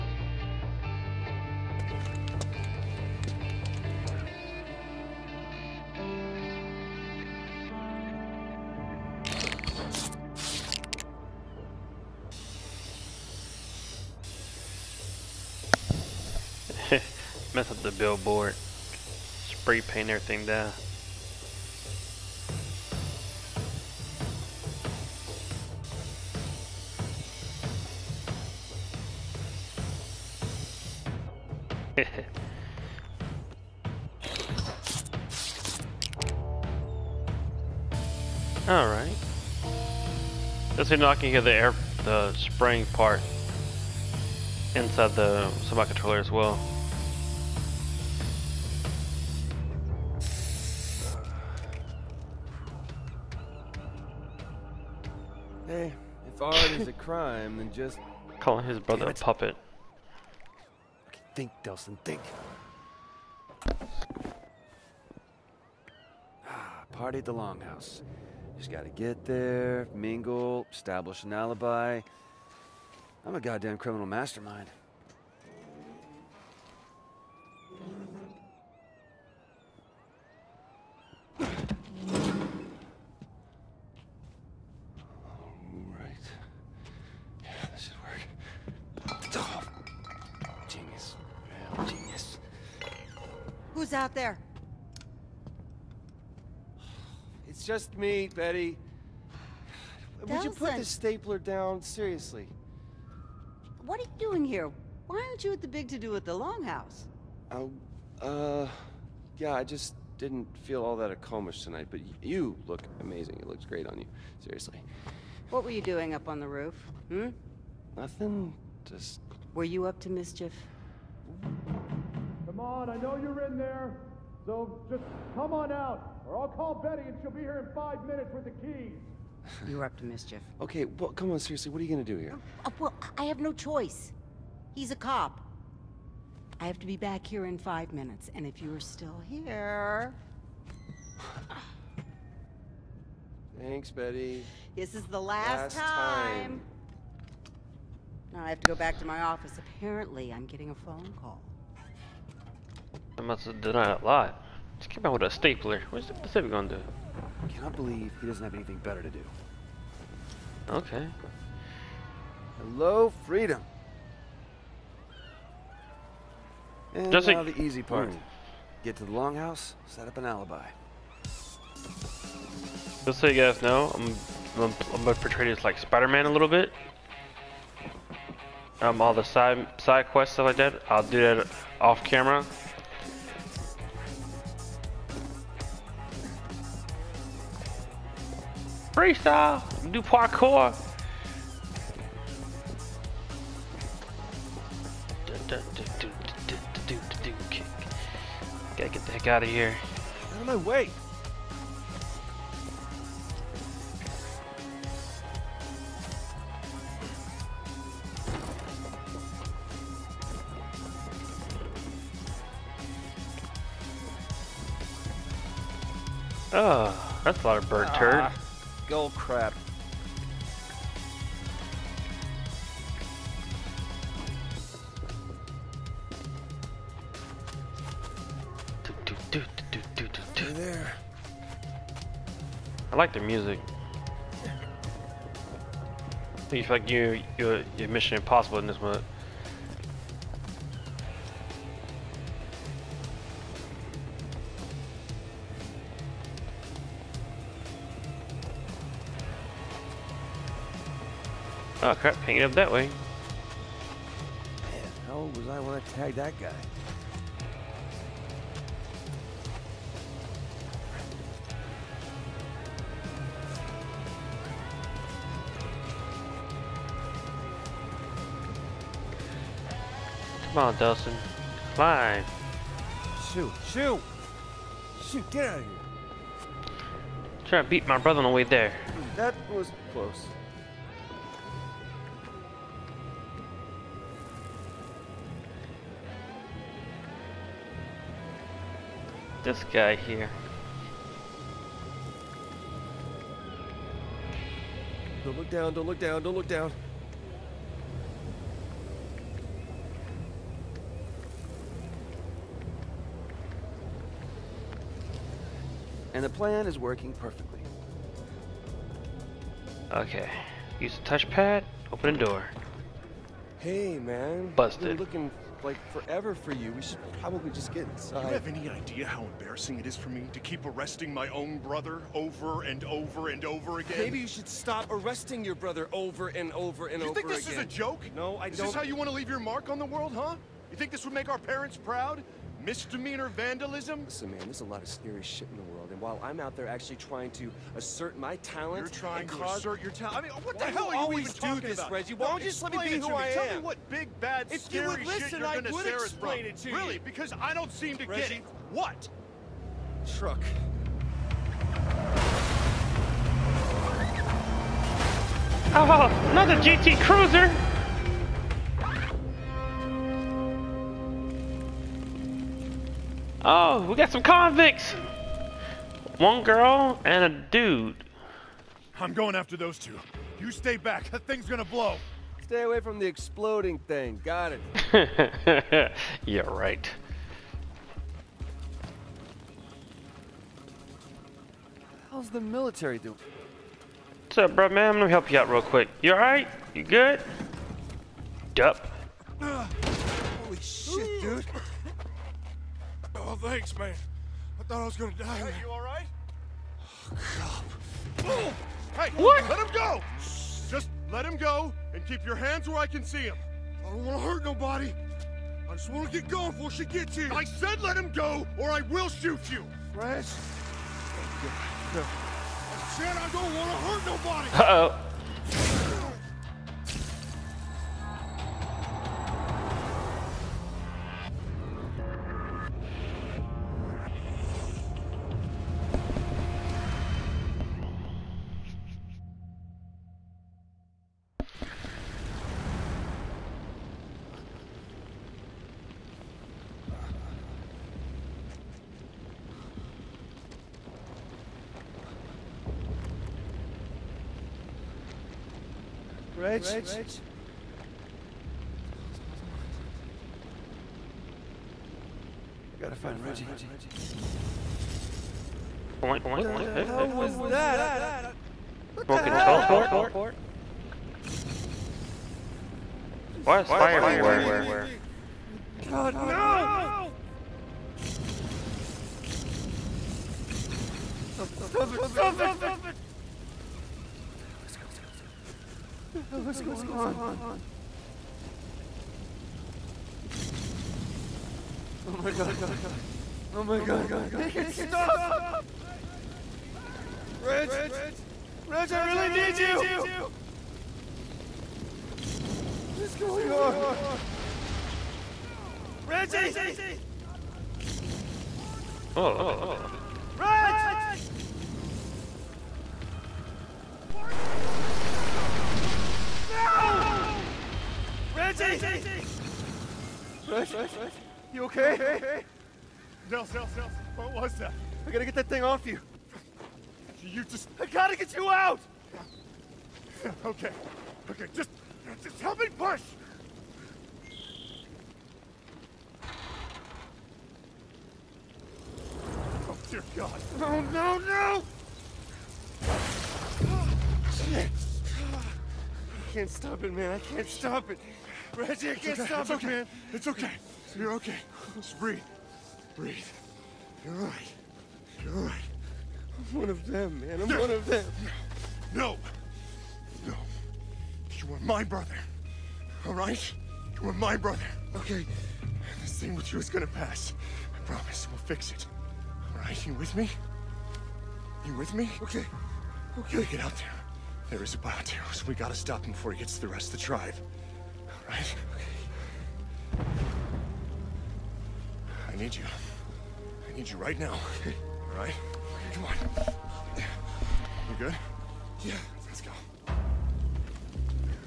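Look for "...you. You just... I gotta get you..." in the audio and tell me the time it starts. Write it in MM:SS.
08:35.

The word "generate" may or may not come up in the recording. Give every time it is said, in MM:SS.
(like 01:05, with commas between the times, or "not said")
not said.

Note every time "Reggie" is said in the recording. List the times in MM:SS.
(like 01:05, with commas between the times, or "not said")
05:41, 05:48, 07:33, 08:16, 08:28, 08:58.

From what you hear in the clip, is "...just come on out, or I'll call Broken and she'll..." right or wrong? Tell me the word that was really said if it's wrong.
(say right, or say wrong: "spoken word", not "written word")
wrong: "Betty", not "Broken".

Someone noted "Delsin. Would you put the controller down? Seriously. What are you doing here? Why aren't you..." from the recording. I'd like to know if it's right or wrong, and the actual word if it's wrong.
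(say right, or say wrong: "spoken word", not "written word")
wrong: "stapler", not "controller".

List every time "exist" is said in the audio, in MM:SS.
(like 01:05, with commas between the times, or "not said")
not said.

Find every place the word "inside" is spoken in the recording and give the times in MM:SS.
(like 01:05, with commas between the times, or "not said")
00:44, 05:17.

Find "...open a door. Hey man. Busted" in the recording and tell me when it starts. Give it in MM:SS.
05:11.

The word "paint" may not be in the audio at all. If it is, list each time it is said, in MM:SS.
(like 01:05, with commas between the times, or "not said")
00:19.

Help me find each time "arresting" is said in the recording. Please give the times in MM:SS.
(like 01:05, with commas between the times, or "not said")
05:20, 05:24.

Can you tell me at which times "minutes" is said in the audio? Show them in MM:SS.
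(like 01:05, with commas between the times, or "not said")
02:08, 02:17.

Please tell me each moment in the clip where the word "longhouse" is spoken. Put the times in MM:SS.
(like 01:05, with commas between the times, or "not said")
01:07, 01:46, 02:49.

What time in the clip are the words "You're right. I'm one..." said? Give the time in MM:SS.
09:05.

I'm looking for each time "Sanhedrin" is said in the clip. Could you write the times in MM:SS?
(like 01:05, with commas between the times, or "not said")
not said.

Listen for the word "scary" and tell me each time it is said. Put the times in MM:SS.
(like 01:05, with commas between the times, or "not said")
05:34, 05:44.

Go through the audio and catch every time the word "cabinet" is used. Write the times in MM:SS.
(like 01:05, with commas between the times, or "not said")
not said.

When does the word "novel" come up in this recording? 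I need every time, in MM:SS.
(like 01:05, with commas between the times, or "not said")
not said.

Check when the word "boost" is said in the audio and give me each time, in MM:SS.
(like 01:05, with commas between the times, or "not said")
not said.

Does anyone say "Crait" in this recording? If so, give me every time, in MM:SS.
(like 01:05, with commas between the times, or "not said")
not said.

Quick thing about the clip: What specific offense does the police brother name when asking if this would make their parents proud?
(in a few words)
Misdemeanor vandalism.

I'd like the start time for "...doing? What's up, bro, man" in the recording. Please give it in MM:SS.
06:22.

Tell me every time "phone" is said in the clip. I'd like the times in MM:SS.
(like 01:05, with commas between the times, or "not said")
02:30.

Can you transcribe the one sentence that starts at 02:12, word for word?
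Uh, well, I have no choice.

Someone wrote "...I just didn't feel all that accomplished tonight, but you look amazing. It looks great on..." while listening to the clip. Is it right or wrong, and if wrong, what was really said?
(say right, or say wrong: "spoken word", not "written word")
right.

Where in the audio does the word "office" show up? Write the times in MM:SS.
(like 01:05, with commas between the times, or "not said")
02:29.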